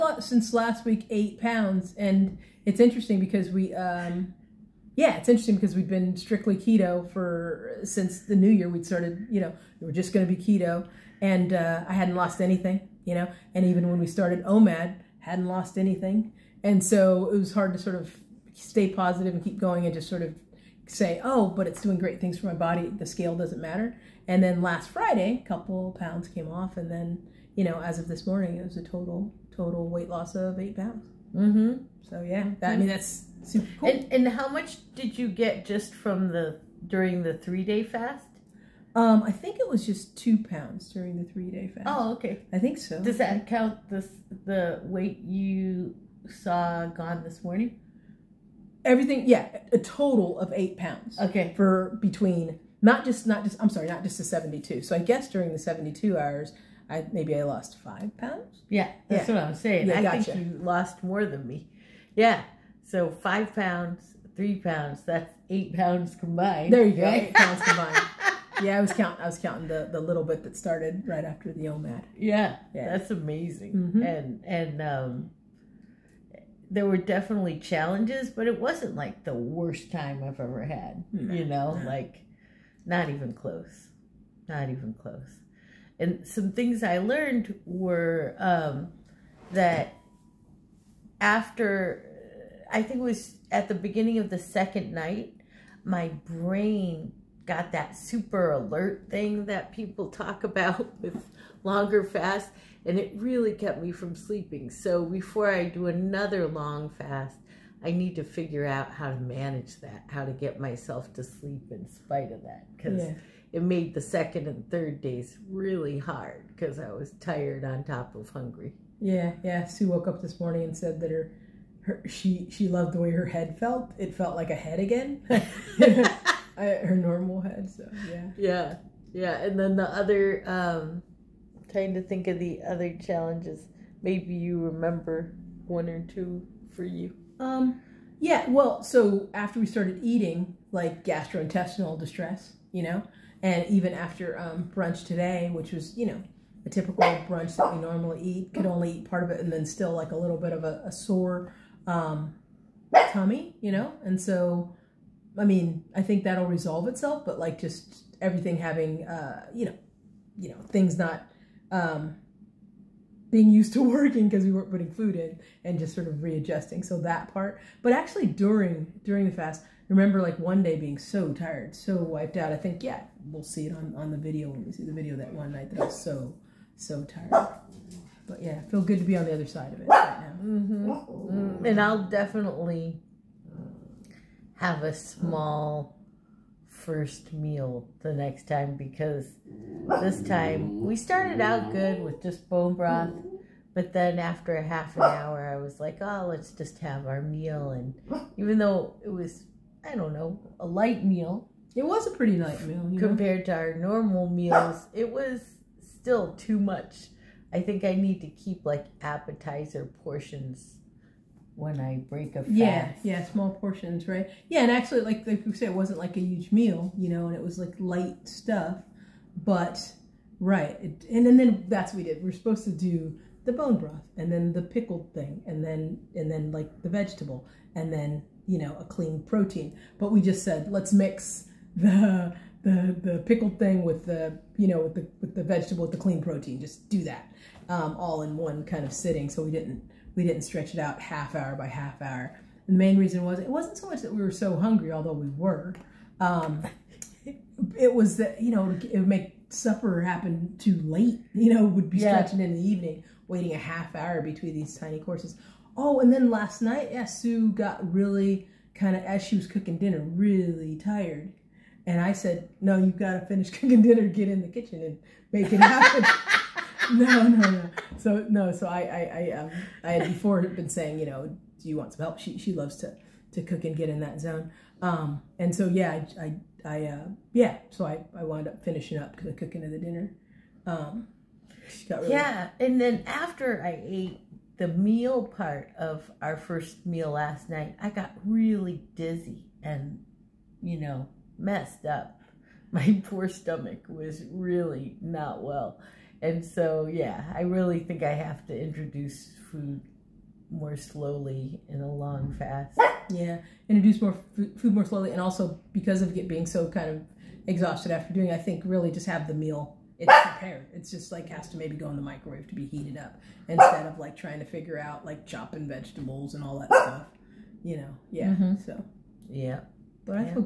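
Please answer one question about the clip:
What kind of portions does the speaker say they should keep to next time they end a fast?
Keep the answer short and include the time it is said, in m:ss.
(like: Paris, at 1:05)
appetizer portions, at 3:29.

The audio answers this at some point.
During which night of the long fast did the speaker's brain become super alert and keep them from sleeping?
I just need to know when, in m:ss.
1:34.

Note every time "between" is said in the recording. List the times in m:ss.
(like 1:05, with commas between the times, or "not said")
0:52, 4:14.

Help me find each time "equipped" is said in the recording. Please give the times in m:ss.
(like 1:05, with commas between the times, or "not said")
not said.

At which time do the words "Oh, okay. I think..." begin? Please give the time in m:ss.
0:41.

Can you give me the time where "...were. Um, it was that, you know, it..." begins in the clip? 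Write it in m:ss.
4:05.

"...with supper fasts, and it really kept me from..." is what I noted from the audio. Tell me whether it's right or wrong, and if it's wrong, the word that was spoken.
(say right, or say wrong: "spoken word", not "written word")
wrong: "longer", not "supper".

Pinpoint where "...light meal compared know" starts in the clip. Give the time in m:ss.
3:22.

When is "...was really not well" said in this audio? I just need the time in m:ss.
4:53.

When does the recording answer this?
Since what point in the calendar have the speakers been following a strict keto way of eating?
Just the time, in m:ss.
0:08.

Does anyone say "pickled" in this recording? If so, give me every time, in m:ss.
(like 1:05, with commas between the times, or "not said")
3:44, 3:53.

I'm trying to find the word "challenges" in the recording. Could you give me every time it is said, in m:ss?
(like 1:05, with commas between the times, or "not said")
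1:17, 2:13.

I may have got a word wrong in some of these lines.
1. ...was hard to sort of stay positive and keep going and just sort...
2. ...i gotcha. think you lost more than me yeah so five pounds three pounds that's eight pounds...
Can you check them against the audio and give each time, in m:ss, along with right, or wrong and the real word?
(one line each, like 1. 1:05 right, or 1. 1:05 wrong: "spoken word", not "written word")
1. 0:17 right
2. 0:59 right.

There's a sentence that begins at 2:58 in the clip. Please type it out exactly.
But yeah, feel good to be on the other side of it right now.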